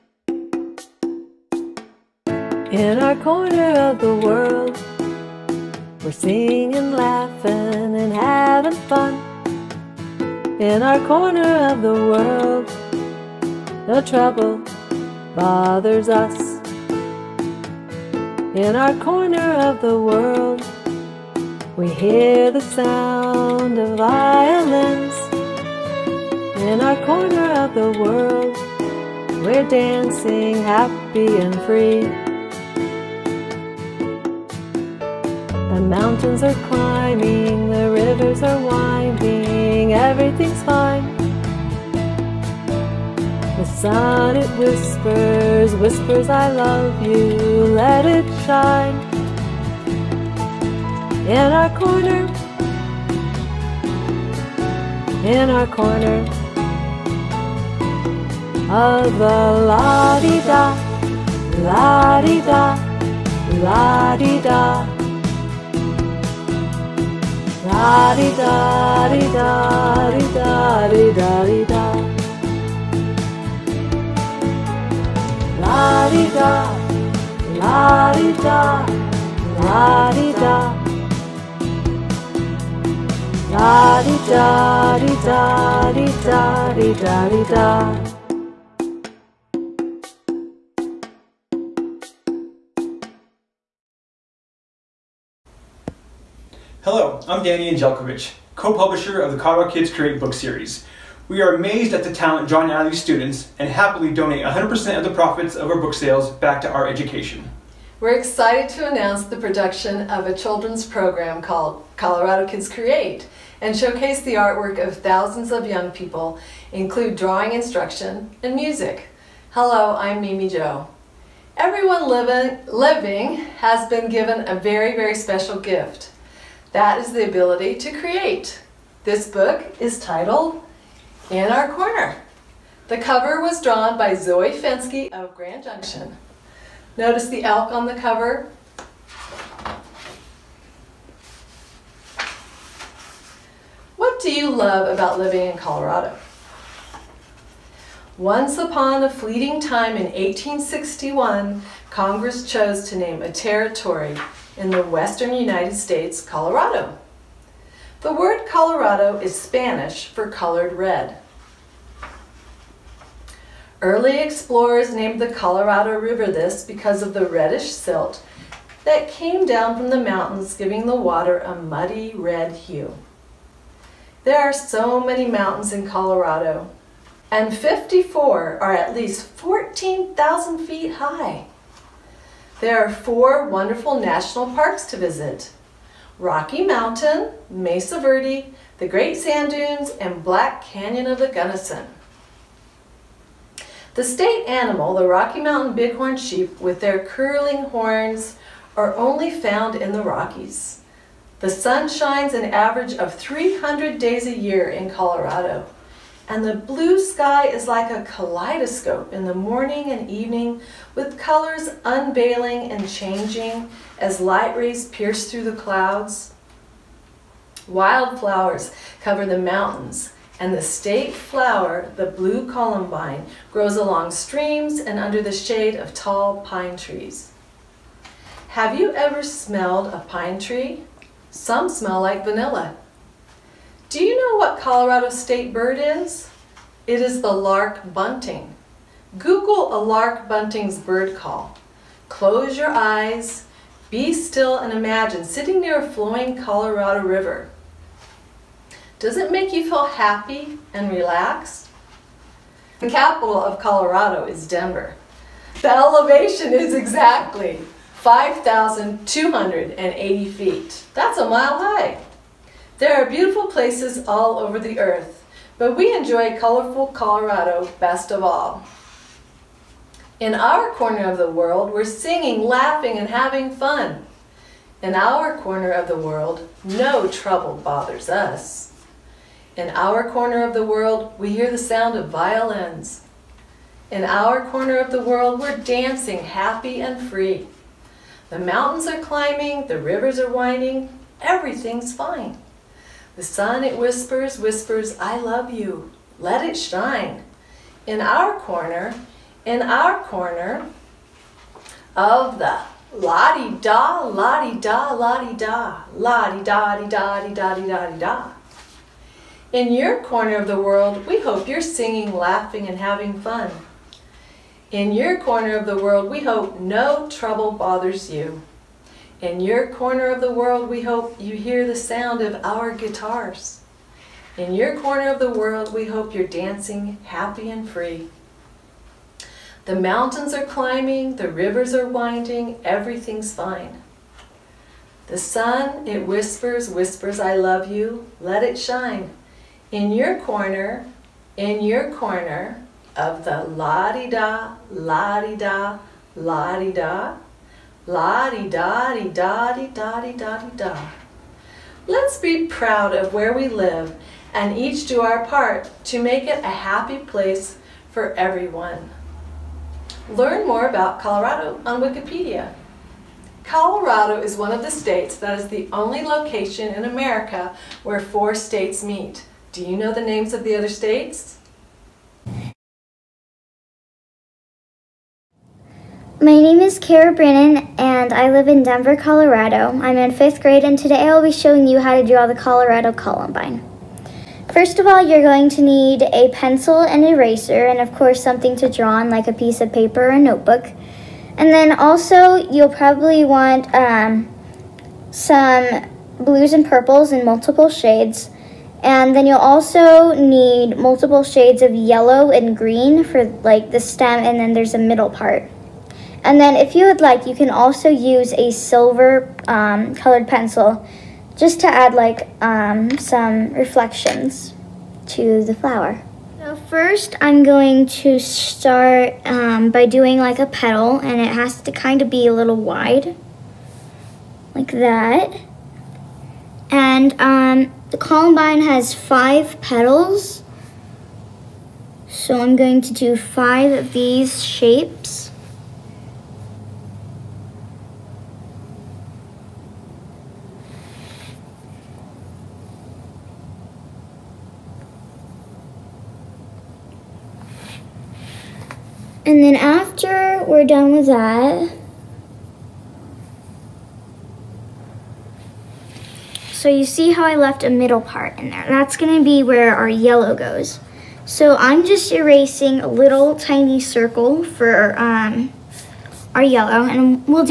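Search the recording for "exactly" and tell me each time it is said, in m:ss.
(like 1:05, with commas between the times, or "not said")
4:16.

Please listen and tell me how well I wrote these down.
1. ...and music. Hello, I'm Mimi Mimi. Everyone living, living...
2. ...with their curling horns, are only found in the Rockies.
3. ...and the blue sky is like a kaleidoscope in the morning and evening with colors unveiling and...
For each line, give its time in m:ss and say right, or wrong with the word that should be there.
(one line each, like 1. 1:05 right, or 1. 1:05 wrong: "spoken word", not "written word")
1. 1:58 wrong: "Joe", not "Mimi"
2. 3:16 right
3. 3:26 right.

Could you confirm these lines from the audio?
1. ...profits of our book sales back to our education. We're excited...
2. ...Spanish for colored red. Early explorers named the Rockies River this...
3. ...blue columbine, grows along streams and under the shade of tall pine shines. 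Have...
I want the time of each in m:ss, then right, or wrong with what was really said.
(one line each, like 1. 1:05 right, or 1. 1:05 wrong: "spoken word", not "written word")
1. 1:45 right
2. 2:39 wrong: "Colorado", not "Rockies"
3. 3:42 wrong: "trees", not "shines".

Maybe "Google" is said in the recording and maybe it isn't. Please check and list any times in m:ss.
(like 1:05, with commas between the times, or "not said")
3:59.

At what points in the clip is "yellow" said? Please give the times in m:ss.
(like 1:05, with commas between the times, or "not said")
6:41, 7:39, 7:46.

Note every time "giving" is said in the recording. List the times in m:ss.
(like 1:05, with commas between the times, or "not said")
2:50.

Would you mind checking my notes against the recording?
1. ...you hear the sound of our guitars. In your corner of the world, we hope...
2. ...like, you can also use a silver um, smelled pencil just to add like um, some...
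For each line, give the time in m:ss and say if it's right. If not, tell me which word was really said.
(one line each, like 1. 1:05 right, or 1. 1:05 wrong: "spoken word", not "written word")
1. 5:21 right
2. 6:46 wrong: "colored", not "smelled".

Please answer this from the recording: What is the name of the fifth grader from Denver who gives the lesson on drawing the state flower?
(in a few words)
Kara Brennan.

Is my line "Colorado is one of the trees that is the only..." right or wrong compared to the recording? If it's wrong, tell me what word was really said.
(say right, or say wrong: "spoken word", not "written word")
wrong: "states", not "trees".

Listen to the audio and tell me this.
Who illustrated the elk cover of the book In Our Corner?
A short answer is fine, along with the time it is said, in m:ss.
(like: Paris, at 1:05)
Zoe Fensky, at 2:14.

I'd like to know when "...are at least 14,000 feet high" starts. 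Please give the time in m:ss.
2:58.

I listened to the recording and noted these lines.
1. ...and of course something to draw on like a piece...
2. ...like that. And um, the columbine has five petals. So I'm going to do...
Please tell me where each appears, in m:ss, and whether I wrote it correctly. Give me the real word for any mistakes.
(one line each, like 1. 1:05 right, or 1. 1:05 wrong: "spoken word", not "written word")
1. 6:27 right
2. 7:04 right.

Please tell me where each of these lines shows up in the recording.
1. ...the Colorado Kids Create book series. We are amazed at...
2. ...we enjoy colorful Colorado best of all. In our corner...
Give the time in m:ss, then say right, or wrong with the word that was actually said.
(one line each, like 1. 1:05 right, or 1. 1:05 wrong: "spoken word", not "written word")
1. 1:39 right
2. 4:25 right.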